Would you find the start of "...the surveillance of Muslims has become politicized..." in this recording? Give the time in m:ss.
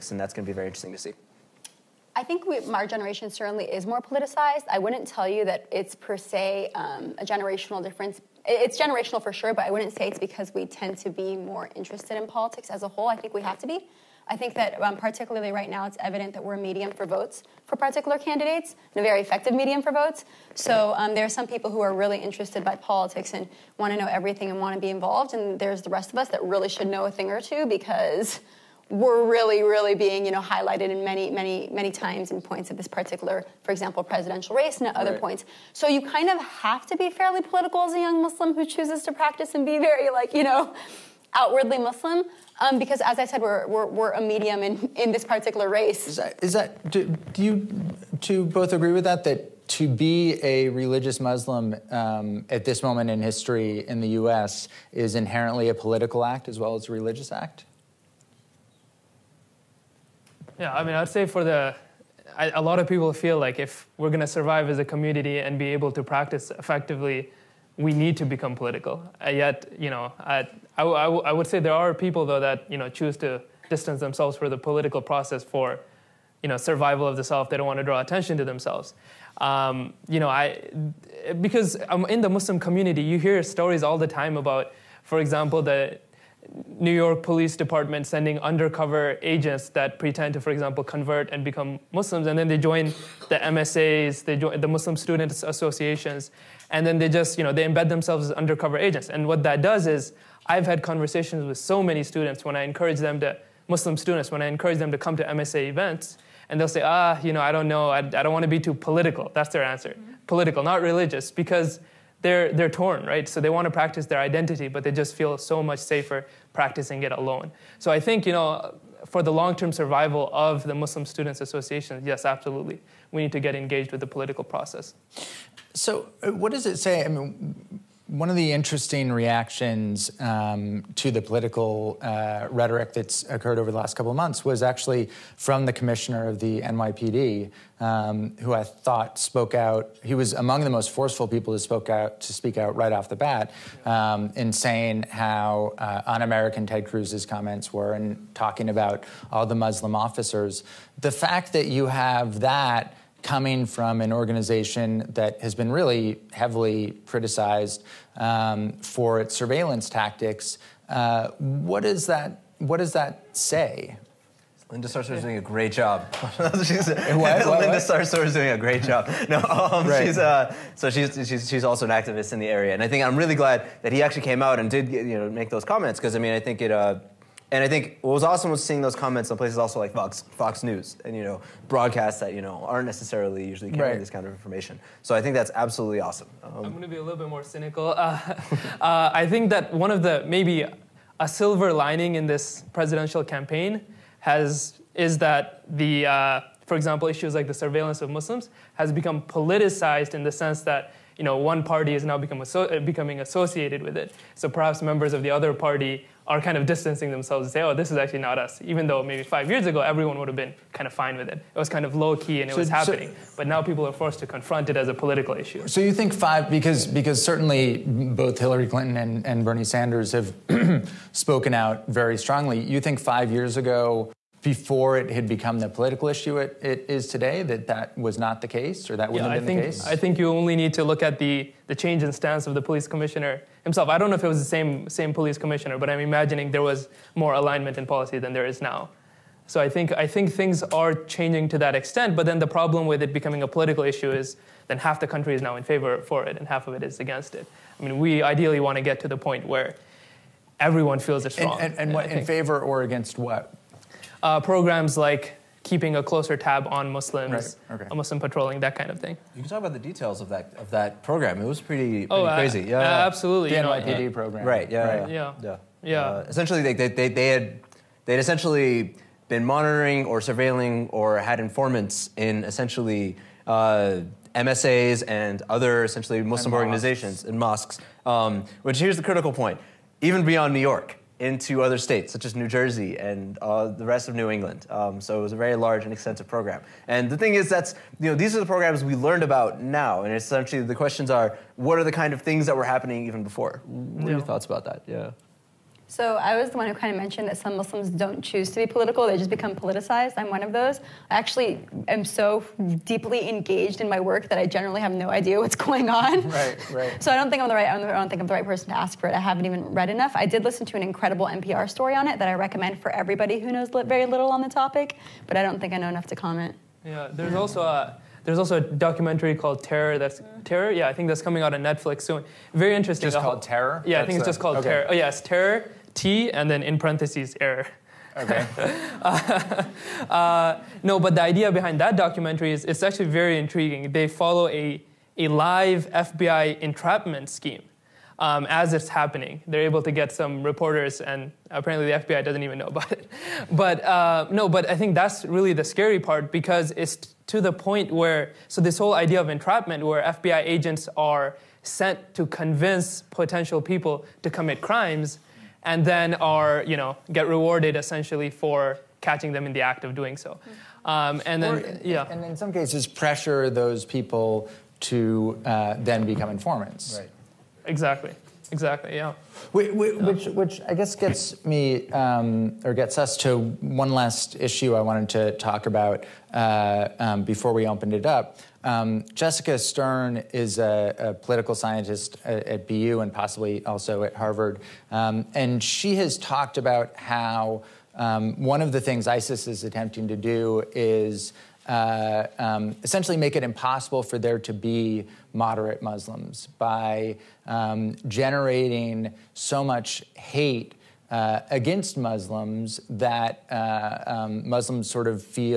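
3:17.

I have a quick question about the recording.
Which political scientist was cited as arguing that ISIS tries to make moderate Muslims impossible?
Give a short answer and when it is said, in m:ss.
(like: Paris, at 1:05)
Jessica Stern, at 6:19.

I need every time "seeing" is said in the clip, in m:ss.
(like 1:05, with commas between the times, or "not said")
2:58.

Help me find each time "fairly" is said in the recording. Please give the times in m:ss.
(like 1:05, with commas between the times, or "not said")
0:37.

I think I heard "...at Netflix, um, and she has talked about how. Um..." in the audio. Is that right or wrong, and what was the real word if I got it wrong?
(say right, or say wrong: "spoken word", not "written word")
wrong: "Harvard", not "Netflix".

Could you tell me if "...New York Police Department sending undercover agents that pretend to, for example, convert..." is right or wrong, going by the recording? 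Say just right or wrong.
right.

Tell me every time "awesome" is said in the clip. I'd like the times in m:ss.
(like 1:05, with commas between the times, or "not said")
2:58, 3:05.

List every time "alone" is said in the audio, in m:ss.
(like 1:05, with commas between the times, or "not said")
1:57.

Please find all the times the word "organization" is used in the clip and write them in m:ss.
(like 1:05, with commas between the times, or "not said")
2:34, 4:36.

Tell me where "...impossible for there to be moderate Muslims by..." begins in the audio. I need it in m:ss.
6:33.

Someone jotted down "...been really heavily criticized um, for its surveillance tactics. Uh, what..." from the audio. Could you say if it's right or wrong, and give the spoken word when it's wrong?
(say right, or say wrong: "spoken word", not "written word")
right.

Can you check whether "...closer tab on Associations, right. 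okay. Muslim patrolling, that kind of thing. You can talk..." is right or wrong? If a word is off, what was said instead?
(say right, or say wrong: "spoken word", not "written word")
wrong: "Muslims", not "Associations".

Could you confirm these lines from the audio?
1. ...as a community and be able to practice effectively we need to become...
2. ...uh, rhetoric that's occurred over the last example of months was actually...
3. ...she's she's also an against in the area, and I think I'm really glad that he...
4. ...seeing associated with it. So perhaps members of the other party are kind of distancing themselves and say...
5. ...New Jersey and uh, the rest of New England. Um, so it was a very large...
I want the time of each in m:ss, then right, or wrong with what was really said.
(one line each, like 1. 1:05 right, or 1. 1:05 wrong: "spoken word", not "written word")
1. 1:04 right
2. 2:11 wrong: "couple", not "example"
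3. 2:51 wrong: "activist", not "against"
4. 3:22 wrong: "becoming", not "seeing"
5. 4:42 right.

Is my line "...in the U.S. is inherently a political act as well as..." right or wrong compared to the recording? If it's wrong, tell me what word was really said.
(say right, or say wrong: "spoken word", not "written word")
right.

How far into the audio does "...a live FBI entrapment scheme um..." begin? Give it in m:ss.
5:35.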